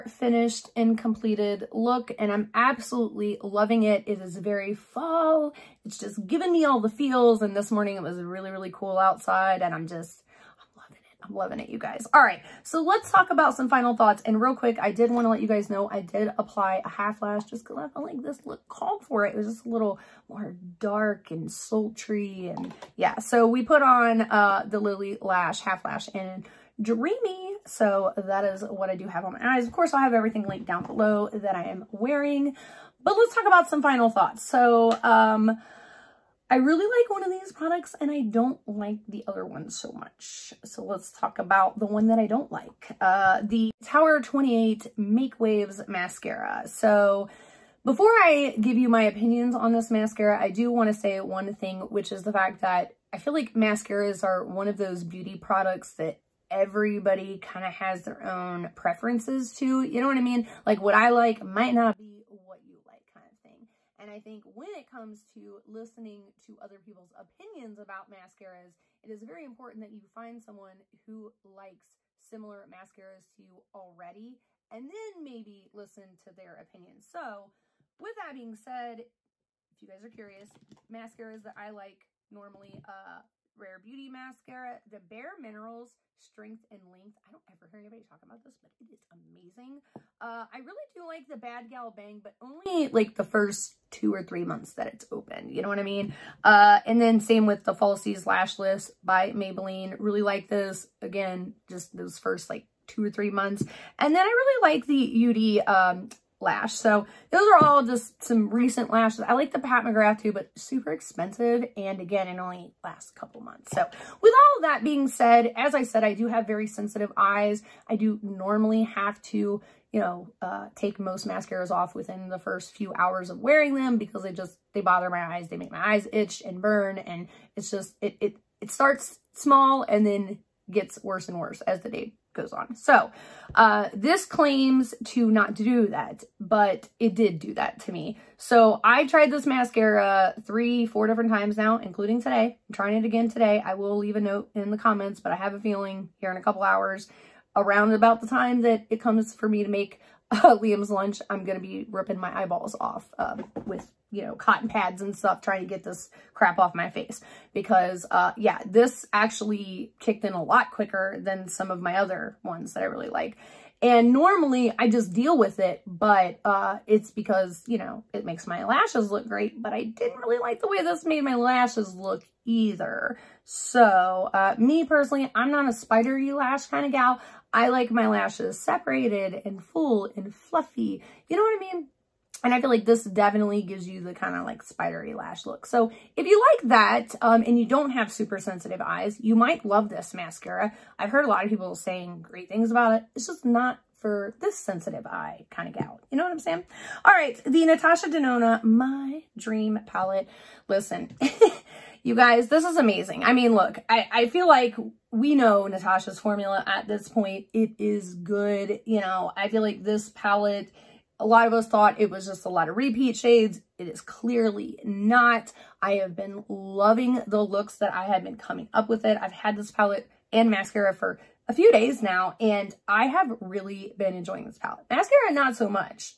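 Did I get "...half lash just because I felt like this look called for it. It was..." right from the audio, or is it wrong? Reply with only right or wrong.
right.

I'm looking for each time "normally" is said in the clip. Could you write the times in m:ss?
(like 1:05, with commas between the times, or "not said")
1:22, 1:58, 2:44.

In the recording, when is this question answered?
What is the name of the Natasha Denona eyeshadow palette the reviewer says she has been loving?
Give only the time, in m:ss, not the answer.
3:18.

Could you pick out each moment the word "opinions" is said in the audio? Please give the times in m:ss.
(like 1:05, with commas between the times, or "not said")
0:49, 1:07, 1:16.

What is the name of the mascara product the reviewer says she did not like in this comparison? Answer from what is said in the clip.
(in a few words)
Make Waves Mascara.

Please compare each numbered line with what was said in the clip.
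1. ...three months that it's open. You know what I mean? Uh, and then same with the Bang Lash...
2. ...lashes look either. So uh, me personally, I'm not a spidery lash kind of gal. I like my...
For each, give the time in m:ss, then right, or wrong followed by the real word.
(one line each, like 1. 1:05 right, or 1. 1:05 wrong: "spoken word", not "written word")
1. 1:34 wrong: "Falsies", not "Bang"
2. 2:51 right.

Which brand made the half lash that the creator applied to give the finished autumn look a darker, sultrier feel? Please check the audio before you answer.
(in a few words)
Lily Lash.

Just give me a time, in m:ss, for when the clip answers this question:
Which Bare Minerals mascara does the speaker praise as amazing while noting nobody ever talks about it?
1:26.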